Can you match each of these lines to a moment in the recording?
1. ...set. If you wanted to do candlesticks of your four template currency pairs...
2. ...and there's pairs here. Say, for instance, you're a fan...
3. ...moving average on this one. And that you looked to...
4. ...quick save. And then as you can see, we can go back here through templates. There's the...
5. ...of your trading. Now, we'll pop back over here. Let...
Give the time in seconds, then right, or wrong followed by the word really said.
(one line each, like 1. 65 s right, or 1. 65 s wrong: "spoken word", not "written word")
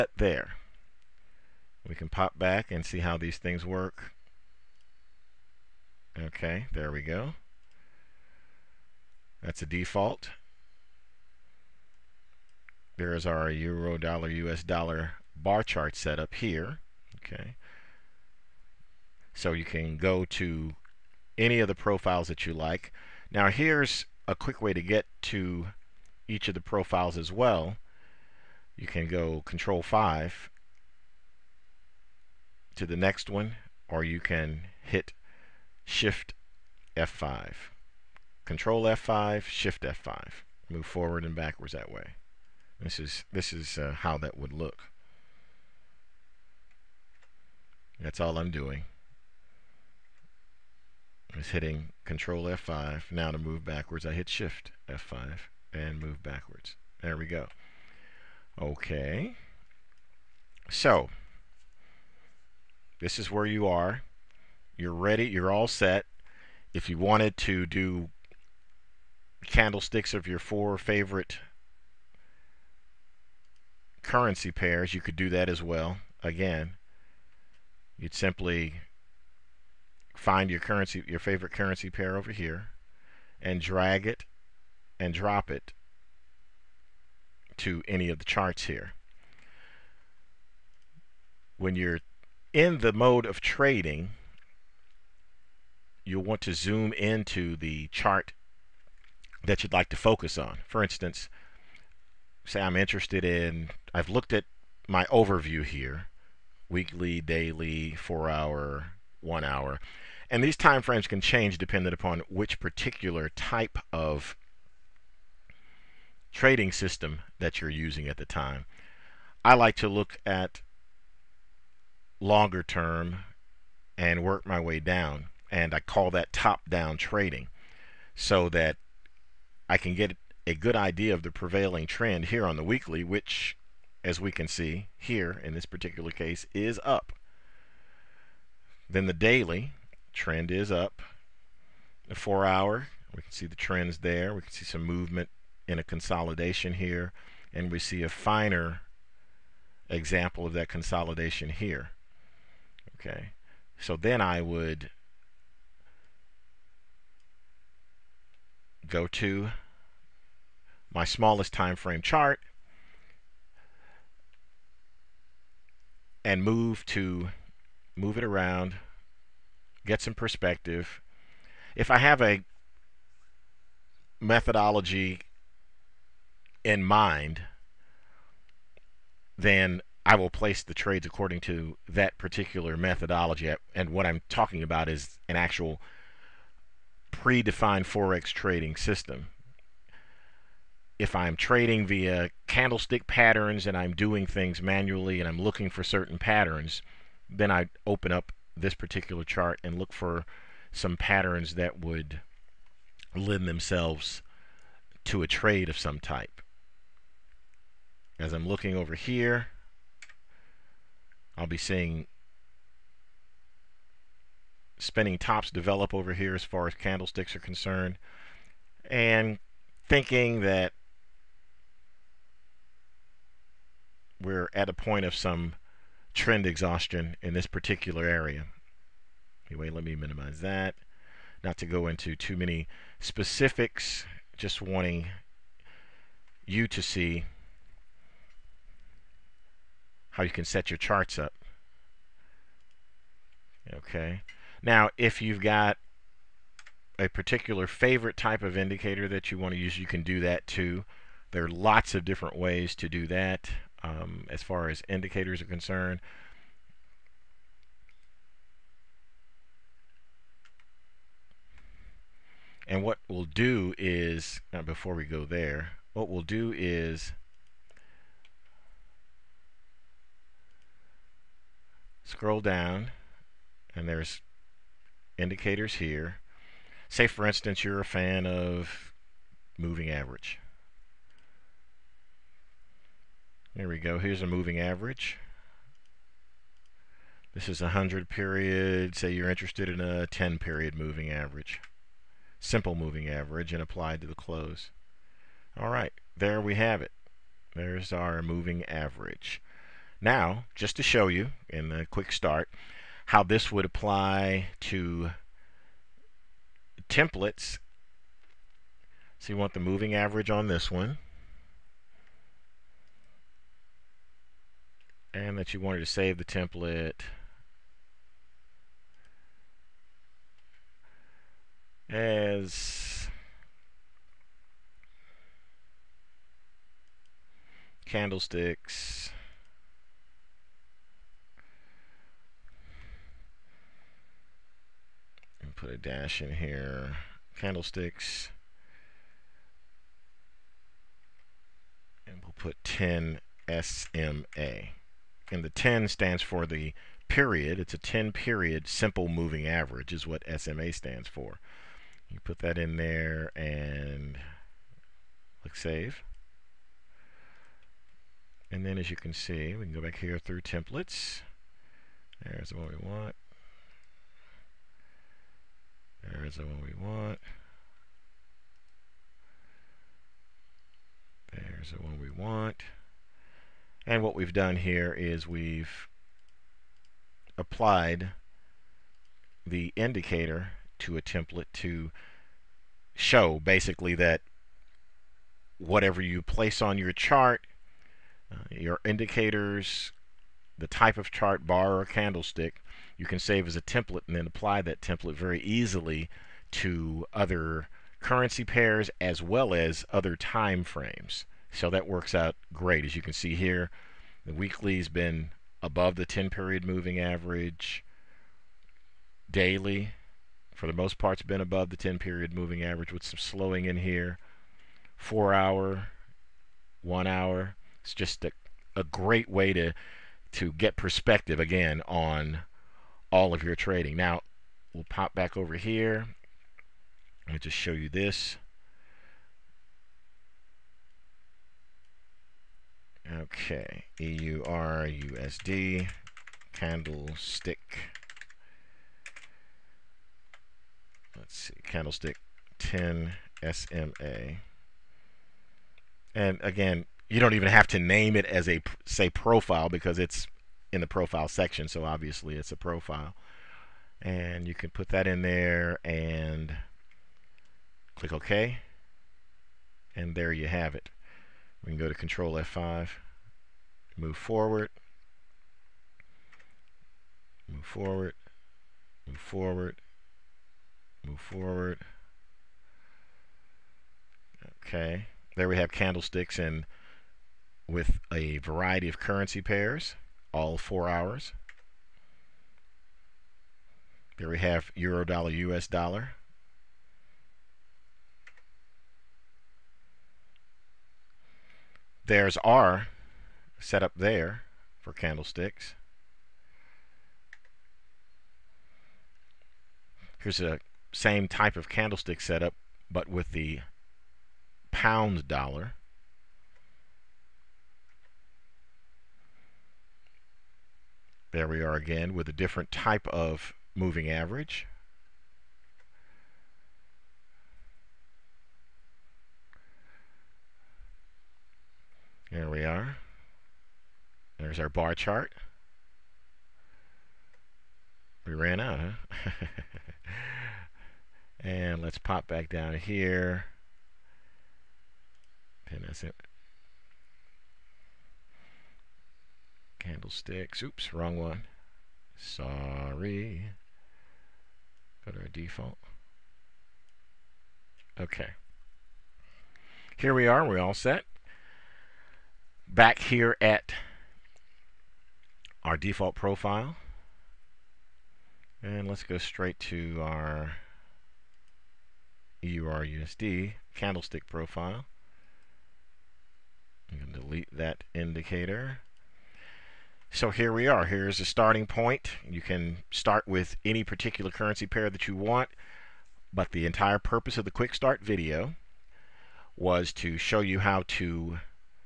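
1. 65 s wrong: "favorite", not "template"
2. 273 s wrong: "indicators", not "pairs"
3. 309 s wrong: "wanted", not "looked"
4. 355 s wrong: "click", not "quick"
5. 423 s right.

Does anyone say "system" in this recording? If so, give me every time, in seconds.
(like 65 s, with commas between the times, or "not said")
116 s, 188 s.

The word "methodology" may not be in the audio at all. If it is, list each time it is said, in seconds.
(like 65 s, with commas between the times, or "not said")
174 s, 182 s.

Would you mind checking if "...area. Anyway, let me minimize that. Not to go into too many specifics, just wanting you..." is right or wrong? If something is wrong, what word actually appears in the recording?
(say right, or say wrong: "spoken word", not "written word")
right.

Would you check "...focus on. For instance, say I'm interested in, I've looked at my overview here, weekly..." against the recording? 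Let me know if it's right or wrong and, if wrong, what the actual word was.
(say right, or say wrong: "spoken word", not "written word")
right.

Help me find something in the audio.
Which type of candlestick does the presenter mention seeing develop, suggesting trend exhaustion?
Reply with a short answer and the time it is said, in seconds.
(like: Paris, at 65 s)
spinning tops, at 214 s.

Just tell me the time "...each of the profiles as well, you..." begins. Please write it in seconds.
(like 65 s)
26 s.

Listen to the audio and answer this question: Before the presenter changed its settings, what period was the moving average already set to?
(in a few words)
100.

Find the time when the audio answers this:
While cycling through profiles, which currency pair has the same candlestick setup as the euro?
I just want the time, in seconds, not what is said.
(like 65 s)
504 s.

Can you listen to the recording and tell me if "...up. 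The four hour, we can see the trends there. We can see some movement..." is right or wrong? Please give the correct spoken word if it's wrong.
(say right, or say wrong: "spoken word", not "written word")
right.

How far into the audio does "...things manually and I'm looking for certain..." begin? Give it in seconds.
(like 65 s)
194 s.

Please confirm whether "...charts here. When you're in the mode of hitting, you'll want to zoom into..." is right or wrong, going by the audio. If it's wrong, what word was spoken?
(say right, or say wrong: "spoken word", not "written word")
wrong: "trading", not "hitting".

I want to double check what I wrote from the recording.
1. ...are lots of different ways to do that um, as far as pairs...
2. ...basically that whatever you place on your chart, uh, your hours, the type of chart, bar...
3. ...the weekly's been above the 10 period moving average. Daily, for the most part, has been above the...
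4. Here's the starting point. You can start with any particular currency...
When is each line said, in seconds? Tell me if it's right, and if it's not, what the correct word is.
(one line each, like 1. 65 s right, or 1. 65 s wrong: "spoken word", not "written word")
1. 251 s wrong: "indicators", not "pairs"
2. 383 s wrong: "indicators", not "hours"
3. 404 s right
4. 570 s right.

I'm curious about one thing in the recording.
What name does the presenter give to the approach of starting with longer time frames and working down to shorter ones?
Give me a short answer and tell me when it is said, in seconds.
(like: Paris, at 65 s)
top down trading, at 126 s.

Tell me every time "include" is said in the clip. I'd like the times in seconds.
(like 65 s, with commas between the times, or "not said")
not said.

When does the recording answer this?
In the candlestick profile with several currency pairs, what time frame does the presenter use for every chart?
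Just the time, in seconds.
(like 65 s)
480 s.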